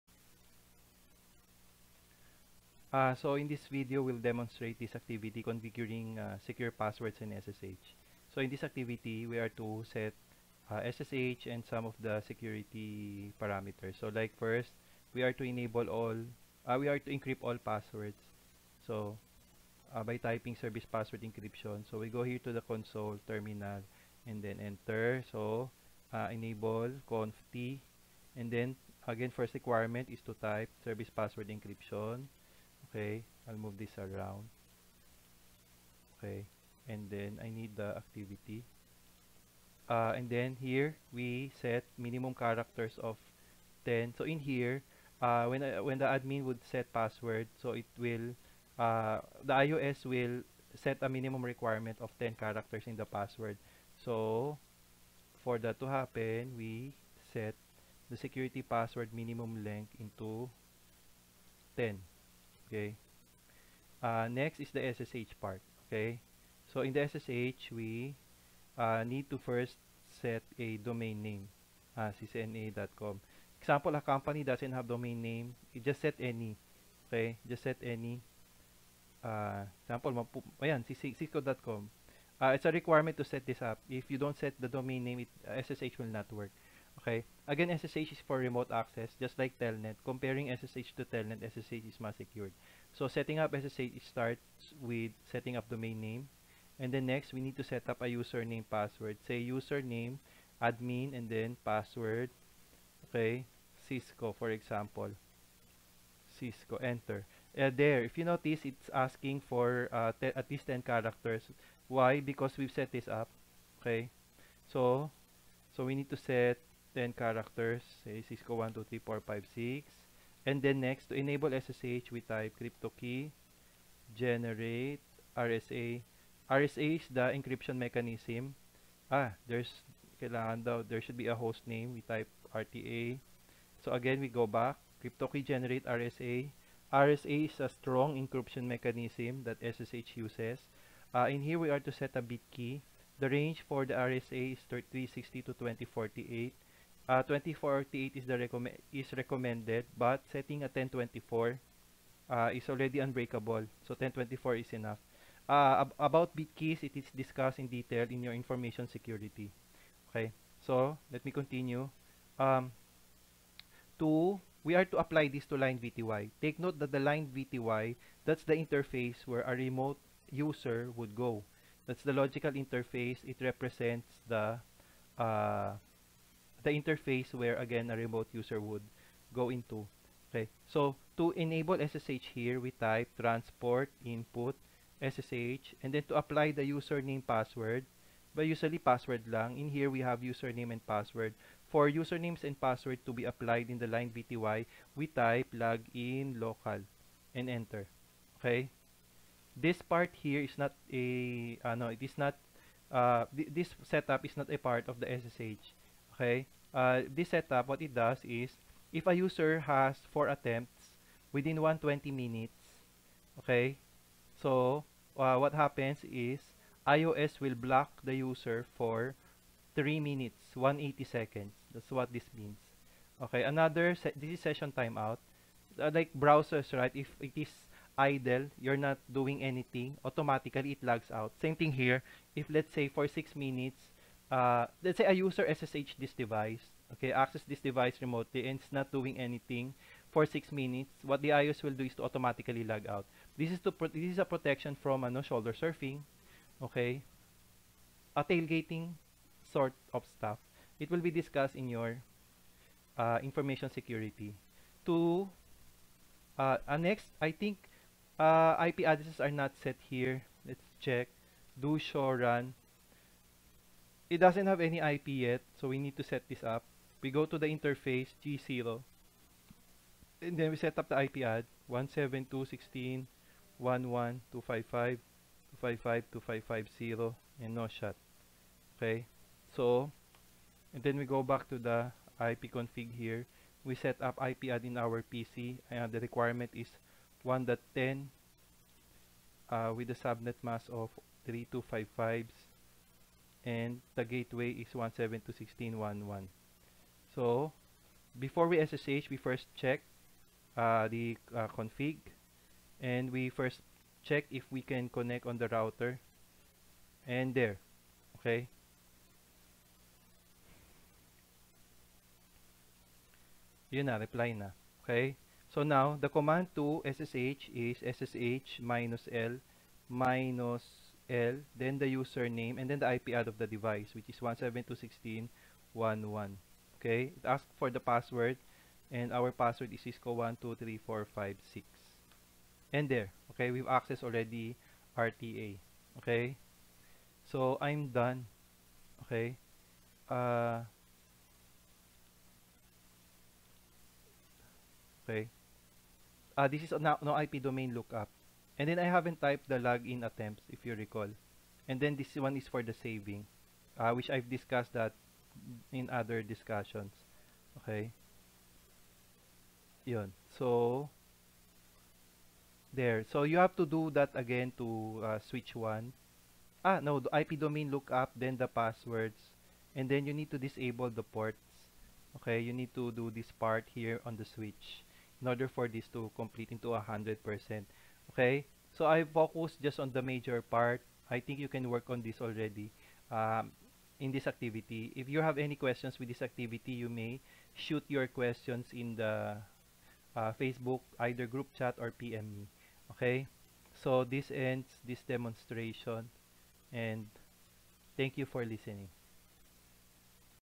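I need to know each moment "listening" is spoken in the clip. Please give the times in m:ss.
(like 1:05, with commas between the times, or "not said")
6:38.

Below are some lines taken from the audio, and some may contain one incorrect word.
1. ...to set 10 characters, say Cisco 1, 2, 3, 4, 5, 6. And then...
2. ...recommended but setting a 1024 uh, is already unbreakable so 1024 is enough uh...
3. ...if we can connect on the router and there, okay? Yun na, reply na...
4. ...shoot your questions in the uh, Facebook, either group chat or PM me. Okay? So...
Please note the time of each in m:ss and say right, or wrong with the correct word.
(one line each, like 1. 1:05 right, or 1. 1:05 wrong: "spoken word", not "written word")
1. 1:56 right
2. 2:29 right
3. 5:04 right
4. 6:27 right.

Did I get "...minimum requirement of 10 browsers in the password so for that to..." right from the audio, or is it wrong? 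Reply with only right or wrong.
wrong.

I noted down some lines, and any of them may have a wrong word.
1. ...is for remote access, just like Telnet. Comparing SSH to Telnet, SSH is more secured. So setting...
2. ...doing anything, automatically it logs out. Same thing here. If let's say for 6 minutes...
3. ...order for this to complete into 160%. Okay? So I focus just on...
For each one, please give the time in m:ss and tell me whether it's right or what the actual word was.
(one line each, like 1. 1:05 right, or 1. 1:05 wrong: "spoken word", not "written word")
1. 1:28 right
2. 3:49 right
3. 6:15 wrong: "100", not "160".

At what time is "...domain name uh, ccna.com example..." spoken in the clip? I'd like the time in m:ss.
1:10.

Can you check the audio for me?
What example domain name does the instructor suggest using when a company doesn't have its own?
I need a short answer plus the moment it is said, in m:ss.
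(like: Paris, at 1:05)
cisco.com, at 1:20.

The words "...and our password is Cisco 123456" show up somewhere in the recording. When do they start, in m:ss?
5:28.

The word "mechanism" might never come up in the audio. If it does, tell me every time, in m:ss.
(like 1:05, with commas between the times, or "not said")
2:07, 2:18.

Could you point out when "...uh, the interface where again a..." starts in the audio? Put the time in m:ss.
2:55.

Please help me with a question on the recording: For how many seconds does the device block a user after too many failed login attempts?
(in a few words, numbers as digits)
180.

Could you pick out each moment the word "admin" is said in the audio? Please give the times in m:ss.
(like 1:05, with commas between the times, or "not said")
0:46, 1:40.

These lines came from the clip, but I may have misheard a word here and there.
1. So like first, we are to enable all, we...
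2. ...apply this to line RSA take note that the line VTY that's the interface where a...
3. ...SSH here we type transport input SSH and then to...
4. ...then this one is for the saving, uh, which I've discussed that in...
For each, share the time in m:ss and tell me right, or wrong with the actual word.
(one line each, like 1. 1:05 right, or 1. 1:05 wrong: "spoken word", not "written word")
1. 0:13 right
2. 2:44 wrong: "VTY", not "RSA"
3. 3:01 right
4. 5:51 right.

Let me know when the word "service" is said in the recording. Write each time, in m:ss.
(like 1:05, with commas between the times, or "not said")
0:20, 0:30.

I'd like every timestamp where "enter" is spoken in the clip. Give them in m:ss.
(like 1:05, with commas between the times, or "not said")
0:24, 1:46, 3:17.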